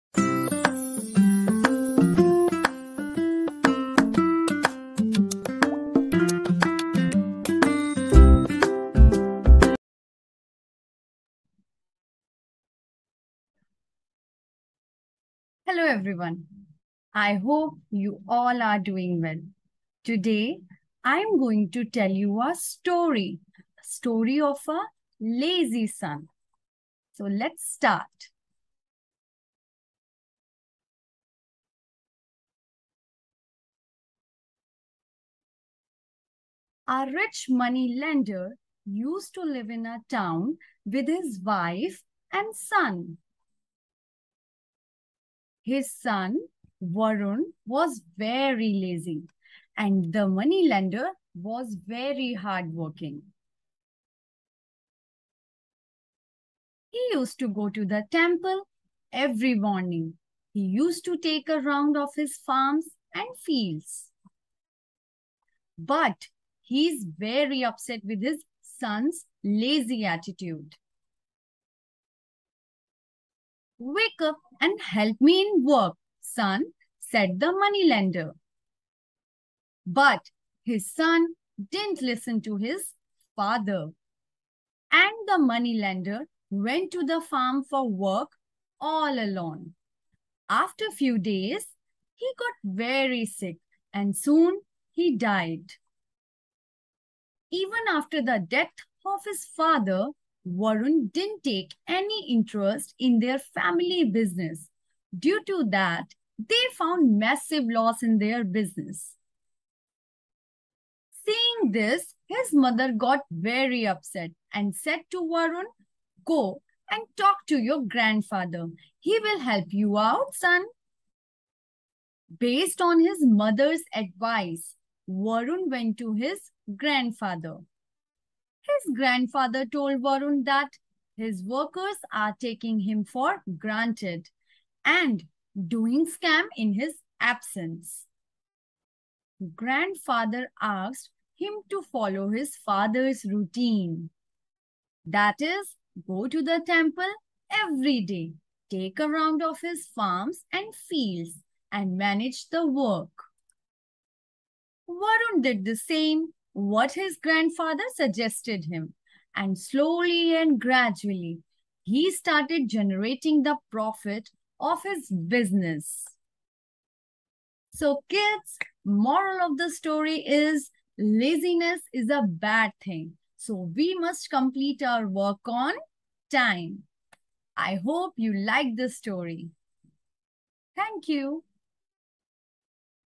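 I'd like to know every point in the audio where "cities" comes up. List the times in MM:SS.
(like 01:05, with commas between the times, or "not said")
not said.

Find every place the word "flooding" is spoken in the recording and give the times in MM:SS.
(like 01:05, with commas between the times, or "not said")
not said.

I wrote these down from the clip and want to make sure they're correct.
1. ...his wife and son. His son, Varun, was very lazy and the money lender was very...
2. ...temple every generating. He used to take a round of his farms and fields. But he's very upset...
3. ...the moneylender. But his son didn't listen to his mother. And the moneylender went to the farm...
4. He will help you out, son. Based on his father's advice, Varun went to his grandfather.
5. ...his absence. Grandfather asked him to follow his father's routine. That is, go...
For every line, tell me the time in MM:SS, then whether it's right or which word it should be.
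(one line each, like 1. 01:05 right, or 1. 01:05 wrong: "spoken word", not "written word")
1. 00:41 right
2. 00:58 wrong: "morning", not "generating"
3. 01:17 wrong: "father", not "mother"
4. 01:58 wrong: "mother", not "father"
5. 02:16 right.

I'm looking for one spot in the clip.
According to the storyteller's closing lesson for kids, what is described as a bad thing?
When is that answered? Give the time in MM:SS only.
02:50.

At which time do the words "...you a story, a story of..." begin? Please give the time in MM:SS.
00:22.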